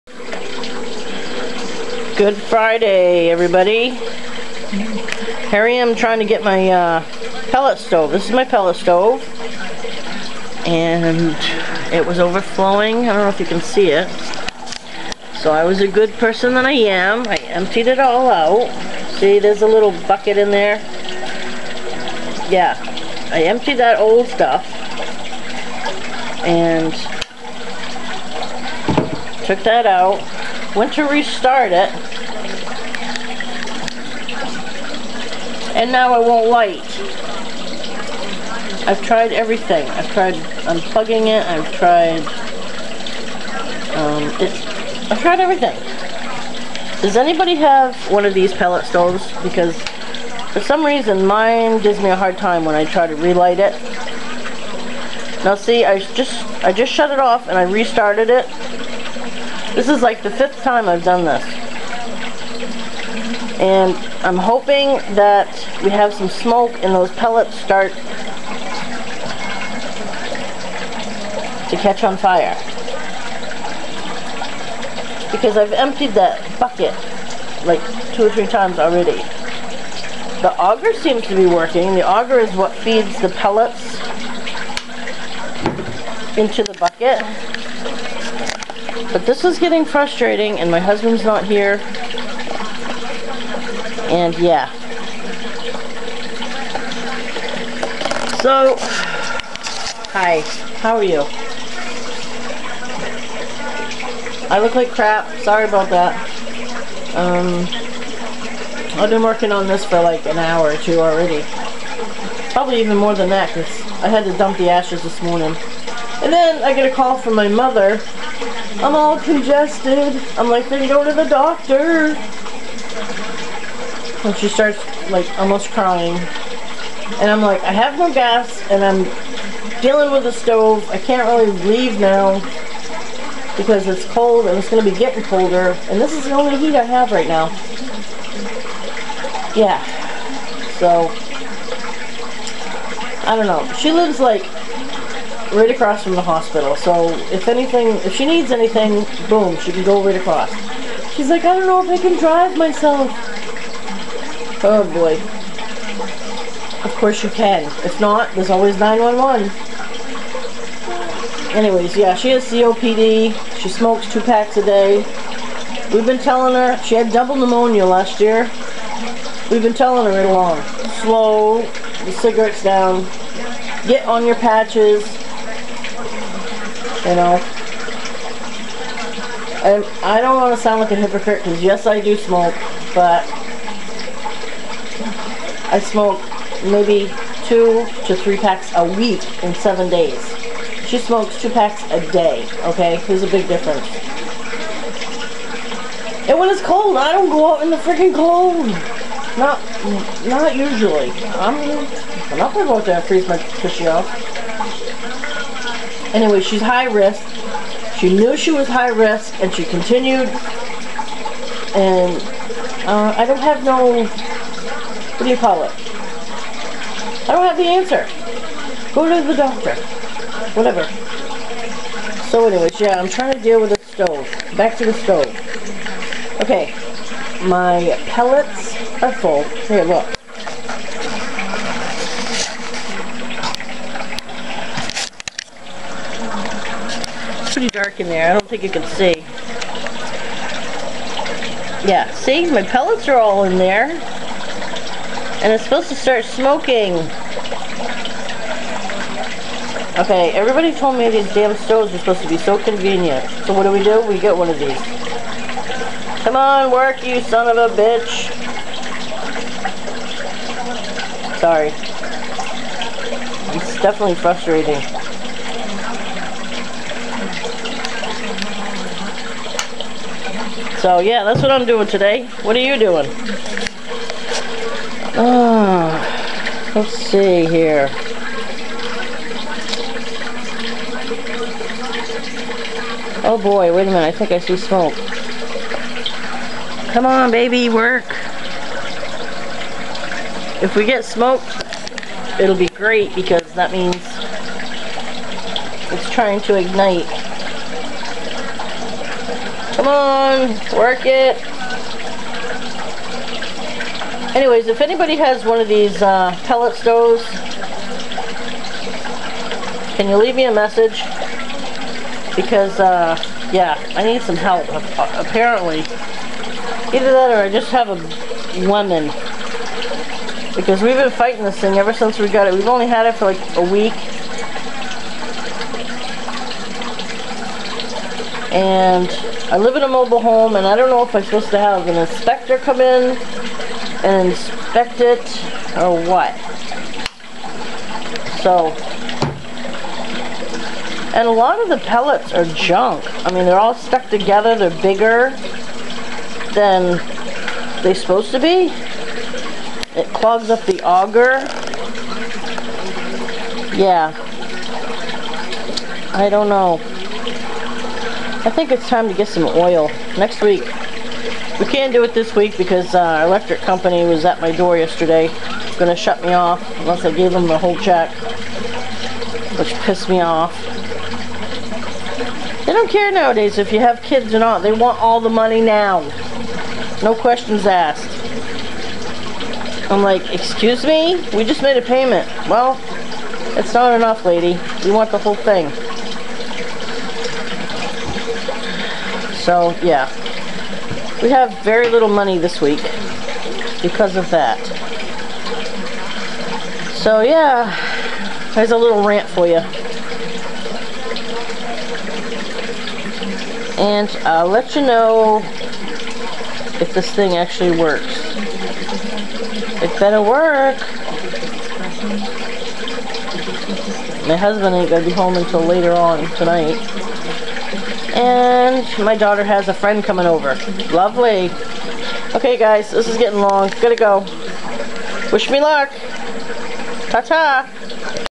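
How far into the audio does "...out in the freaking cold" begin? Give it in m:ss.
3:17.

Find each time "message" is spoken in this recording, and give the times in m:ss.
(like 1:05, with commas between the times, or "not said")
5:10.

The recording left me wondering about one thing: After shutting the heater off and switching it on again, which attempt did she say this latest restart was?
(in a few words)
fifth.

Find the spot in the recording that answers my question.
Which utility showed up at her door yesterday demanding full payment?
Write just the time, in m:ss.
6:03.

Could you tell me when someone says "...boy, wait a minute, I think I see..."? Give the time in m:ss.
4:43.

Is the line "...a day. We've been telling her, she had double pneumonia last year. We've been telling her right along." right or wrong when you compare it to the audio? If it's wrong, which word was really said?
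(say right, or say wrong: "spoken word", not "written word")
right.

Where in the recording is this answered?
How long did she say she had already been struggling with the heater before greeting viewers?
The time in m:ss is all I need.
1:50.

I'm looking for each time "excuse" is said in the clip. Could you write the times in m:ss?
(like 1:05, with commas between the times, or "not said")
6:20.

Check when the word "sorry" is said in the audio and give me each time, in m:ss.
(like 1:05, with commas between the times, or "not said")
1:45, 4:21.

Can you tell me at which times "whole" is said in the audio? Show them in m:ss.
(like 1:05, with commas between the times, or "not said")
6:07, 6:25.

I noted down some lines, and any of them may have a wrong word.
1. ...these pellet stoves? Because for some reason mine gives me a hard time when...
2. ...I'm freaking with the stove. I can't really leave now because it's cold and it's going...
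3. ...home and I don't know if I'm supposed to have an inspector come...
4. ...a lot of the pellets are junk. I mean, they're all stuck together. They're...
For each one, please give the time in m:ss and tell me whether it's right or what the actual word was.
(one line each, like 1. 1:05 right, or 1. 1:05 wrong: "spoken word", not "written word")
1. 0:48 right
2. 2:08 wrong: "dealing", not "freaking"
3. 5:30 right
4. 5:41 right.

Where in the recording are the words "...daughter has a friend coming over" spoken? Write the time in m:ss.
6:59.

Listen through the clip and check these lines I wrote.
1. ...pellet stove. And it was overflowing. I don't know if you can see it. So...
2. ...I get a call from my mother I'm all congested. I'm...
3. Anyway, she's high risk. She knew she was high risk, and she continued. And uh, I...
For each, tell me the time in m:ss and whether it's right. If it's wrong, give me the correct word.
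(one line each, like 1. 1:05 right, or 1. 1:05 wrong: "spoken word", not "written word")
1. 0:08 right
2. 1:56 right
3. 3:26 right.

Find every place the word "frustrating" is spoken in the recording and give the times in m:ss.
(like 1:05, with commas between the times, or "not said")
1:29, 4:24.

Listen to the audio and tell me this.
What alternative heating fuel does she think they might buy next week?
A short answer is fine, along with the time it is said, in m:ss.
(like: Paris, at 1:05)
oil, at 5:59.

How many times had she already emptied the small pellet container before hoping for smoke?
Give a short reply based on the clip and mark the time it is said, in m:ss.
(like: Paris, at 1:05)
2 or 3 times, at 1:18.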